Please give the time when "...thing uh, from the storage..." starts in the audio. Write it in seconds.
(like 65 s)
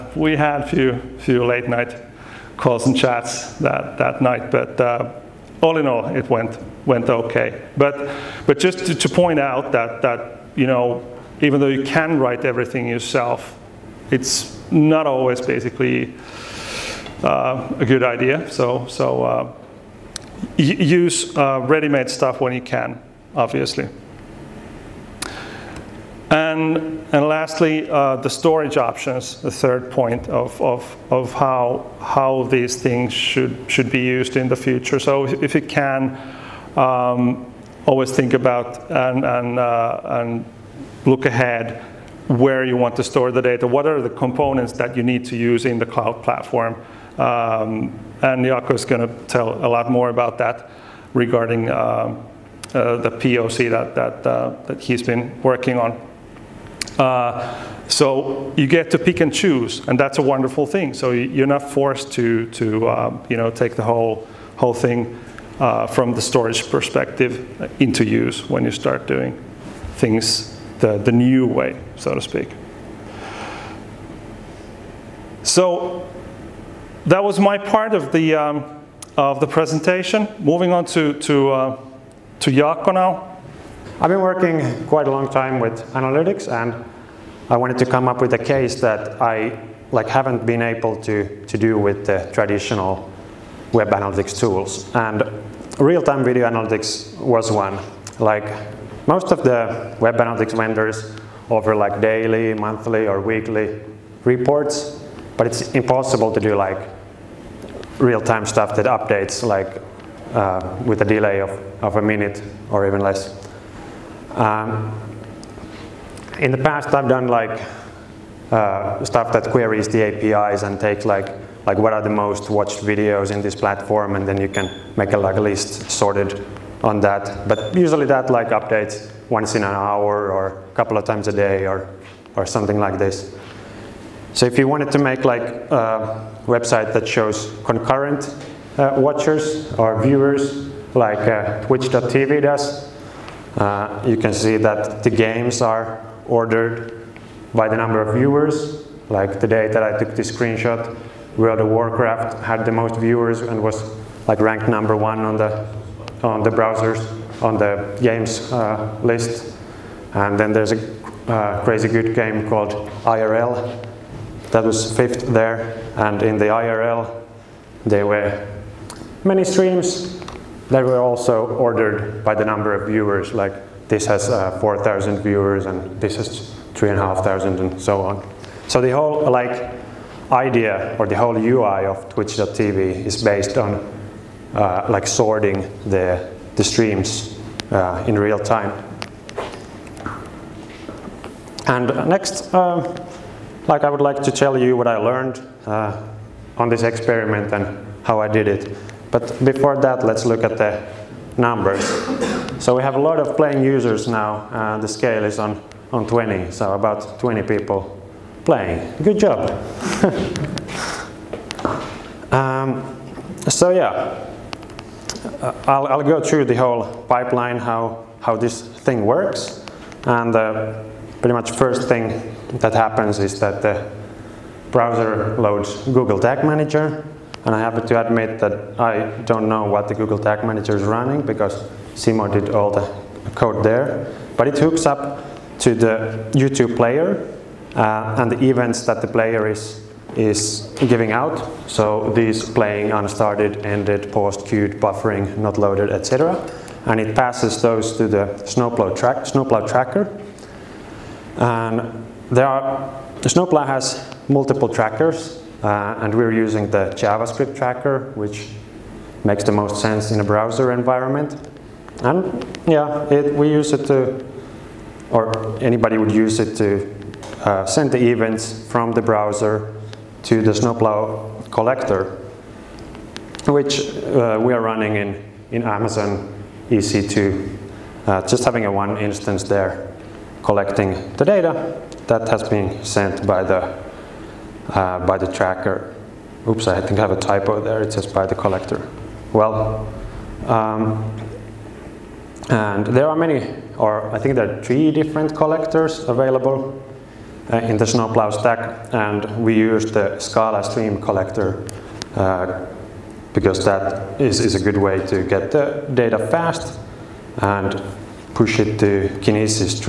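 64 s.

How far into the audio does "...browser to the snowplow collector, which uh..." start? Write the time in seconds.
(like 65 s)
269 s.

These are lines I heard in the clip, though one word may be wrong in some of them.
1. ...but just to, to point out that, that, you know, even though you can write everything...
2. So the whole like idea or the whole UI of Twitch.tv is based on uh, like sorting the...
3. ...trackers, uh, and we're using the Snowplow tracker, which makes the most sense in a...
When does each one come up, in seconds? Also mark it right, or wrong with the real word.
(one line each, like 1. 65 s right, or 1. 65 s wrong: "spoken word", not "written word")
1. 8 s right
2. 178 s right
3. 254 s wrong: "JavaScript", not "Snowplow".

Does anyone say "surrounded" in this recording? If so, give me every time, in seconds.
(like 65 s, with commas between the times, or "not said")
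not said.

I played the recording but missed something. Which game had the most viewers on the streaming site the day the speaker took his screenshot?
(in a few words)
World of Warcraft.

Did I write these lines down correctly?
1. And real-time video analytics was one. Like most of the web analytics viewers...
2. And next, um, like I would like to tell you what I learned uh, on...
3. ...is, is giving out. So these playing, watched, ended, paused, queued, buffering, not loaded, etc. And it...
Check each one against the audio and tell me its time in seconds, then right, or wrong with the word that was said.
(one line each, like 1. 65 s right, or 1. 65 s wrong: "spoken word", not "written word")
1. 94 s wrong: "vendors", not "viewers"
2. 191 s right
3. 239 s wrong: "unstarted", not "watched".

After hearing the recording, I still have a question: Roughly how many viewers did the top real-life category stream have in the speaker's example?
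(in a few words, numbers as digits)
4,000.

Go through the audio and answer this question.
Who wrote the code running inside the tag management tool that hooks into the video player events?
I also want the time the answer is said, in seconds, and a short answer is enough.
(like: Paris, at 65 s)
Simo, at 231 s.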